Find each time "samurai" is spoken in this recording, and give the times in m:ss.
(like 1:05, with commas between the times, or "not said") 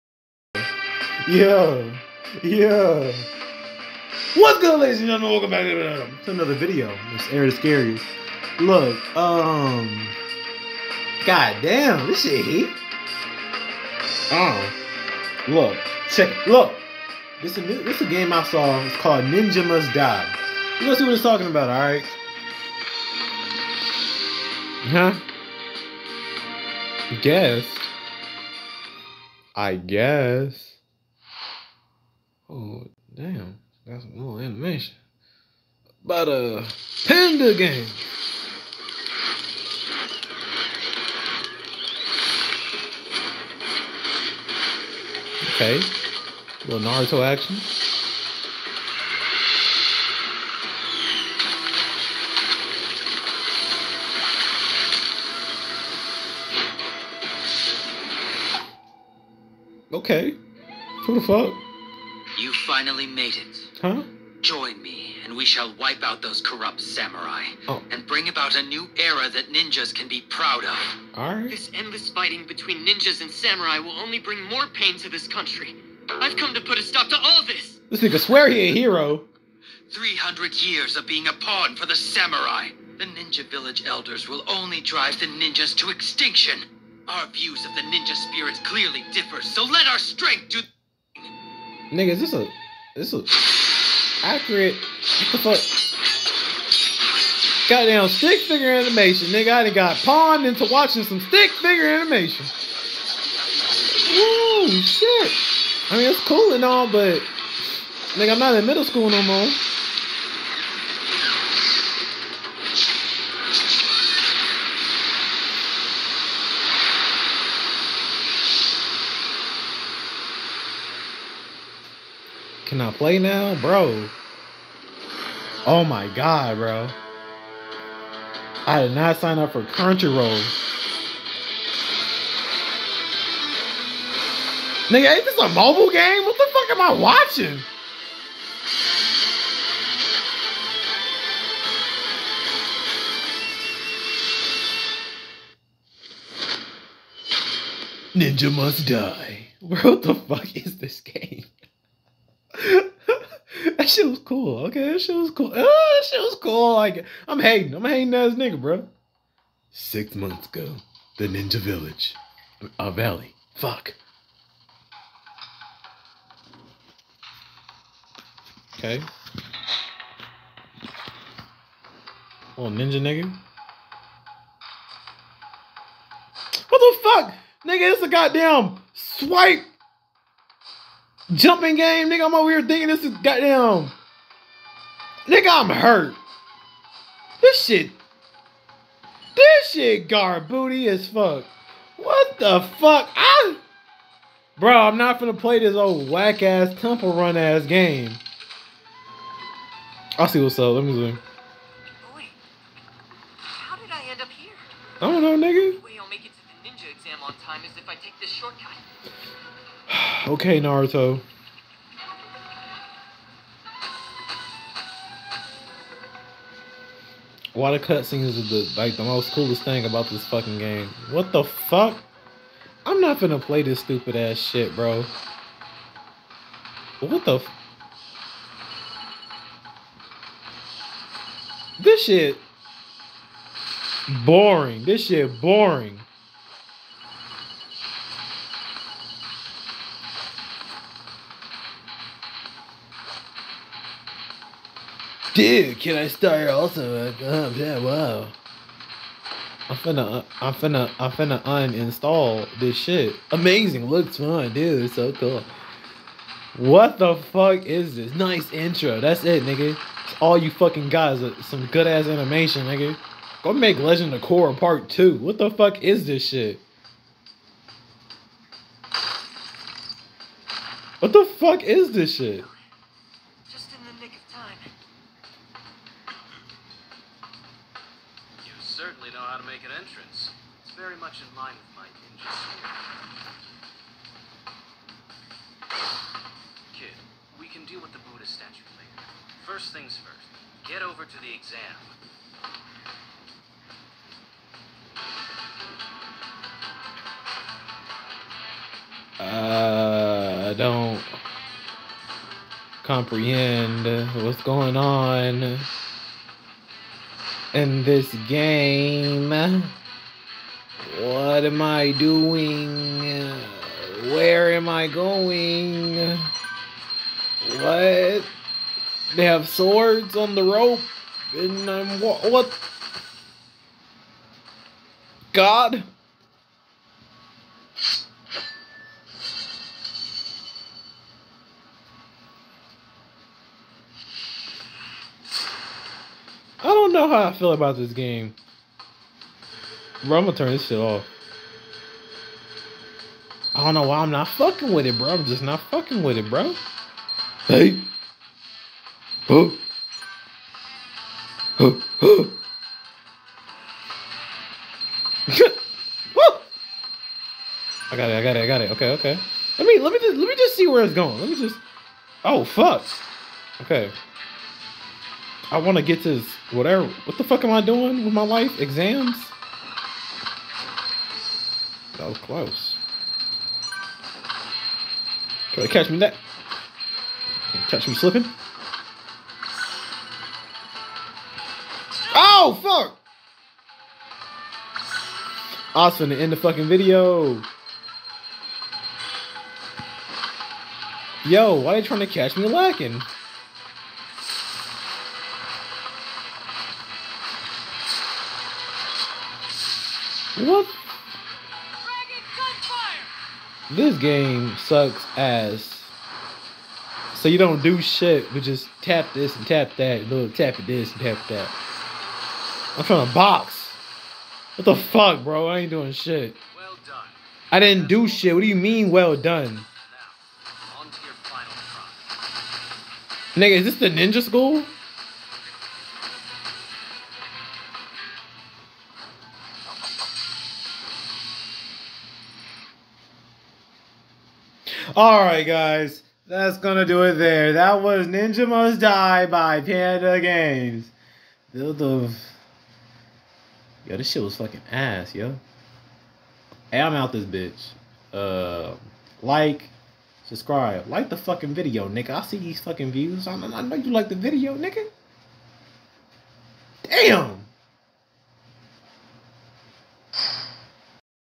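1:06, 1:13, 1:21.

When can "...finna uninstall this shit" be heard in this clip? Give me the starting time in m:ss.
4:11.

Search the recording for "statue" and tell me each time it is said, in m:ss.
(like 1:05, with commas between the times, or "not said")
4:48.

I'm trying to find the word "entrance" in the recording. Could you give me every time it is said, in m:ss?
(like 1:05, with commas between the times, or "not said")
4:39.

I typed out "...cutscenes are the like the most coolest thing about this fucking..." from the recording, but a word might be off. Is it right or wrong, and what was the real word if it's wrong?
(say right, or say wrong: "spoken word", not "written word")
right.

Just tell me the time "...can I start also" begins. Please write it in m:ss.
4:05.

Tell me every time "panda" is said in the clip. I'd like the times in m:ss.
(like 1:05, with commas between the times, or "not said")
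0:37, 7:19.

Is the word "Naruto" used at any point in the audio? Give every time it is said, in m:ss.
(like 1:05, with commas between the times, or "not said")
0:46, 3:30.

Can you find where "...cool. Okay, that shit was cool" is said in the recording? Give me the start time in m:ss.
2:34.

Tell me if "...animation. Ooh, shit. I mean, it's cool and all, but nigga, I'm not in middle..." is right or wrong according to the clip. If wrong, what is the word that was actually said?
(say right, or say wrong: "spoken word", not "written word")
right.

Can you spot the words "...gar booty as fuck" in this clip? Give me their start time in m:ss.
3:10.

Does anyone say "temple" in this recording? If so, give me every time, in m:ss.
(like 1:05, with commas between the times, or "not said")
3:16.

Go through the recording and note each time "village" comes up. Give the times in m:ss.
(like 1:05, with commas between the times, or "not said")
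1:23, 2:41.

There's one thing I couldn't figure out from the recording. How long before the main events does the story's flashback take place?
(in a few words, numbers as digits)
Six months ago.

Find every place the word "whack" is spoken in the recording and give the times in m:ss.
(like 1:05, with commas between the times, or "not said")
3:16.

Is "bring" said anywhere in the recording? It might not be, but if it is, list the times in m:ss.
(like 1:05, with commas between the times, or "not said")
1:08, 1:14.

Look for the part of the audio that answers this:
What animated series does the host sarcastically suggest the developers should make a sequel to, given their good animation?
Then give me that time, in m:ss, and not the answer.
4:23.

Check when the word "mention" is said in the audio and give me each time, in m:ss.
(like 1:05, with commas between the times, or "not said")
not said.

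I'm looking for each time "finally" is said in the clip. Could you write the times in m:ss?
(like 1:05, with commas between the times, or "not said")
1:02.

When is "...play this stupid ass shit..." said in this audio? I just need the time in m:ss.
3:43.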